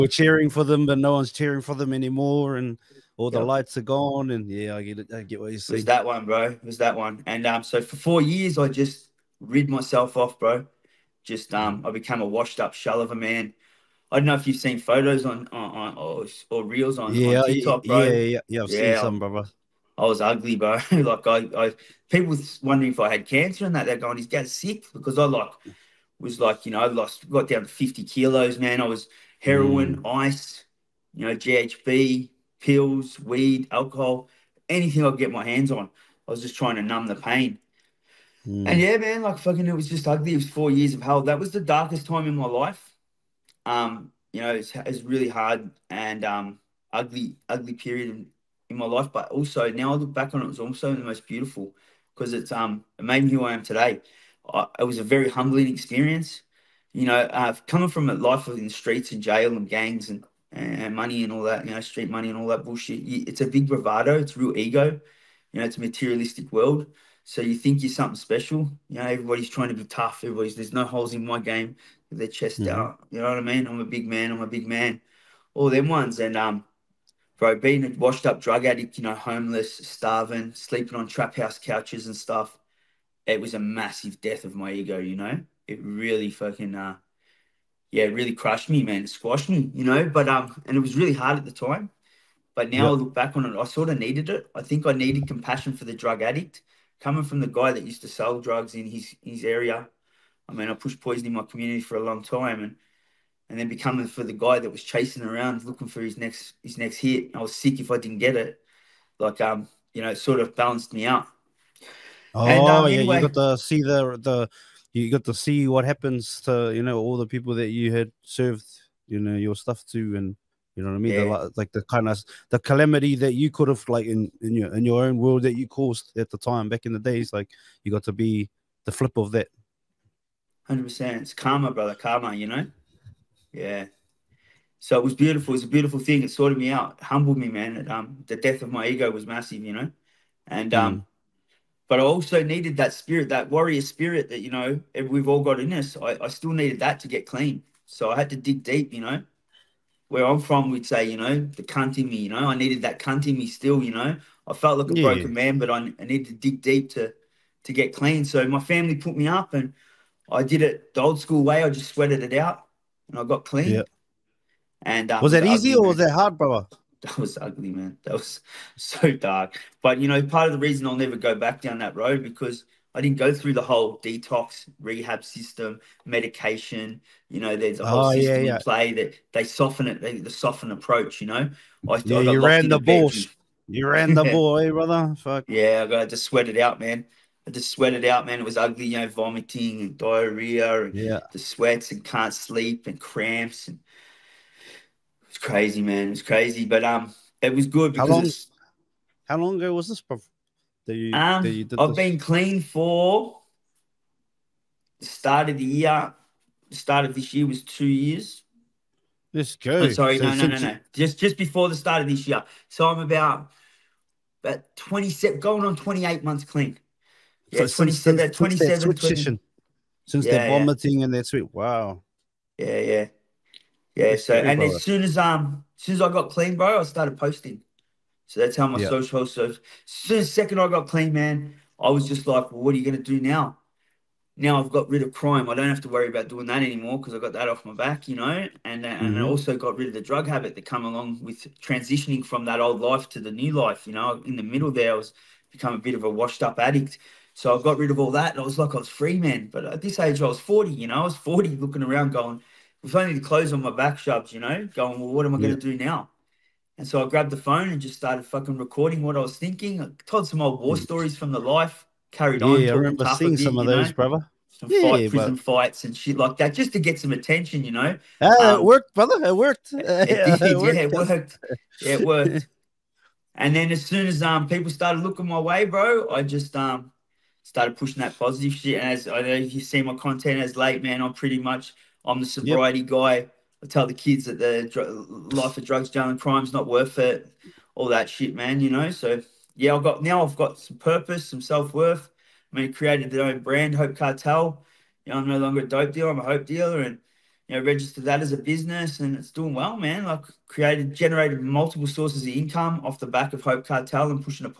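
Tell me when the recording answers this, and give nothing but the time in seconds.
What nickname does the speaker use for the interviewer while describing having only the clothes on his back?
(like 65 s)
253 s.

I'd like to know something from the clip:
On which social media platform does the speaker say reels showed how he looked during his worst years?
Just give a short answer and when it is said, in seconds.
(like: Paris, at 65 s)
TikTok, at 17 s.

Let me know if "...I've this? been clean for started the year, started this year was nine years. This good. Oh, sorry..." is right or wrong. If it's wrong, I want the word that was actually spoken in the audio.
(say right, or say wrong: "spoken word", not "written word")
wrong: "two", not "nine".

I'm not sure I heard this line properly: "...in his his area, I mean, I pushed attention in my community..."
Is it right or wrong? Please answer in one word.
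wrong.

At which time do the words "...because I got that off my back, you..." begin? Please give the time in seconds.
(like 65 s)
236 s.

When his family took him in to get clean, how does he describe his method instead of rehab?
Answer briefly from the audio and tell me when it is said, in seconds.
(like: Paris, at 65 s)
The old school way, at 160 s.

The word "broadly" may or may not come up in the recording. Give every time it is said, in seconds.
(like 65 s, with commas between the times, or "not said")
not said.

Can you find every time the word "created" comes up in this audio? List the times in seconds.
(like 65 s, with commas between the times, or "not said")
292 s, 300 s.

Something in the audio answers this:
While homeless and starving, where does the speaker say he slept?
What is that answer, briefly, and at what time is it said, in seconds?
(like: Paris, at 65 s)
Trap house couches, at 81 s.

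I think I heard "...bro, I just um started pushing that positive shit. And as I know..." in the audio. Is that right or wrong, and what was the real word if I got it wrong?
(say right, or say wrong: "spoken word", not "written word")
right.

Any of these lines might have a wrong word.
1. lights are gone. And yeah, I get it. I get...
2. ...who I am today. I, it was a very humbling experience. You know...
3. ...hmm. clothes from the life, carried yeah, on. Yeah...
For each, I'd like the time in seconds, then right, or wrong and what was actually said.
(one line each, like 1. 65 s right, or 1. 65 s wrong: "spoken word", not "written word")
1. 3 s right
2. 53 s right
3. 260 s wrong: "stories", not "clothes".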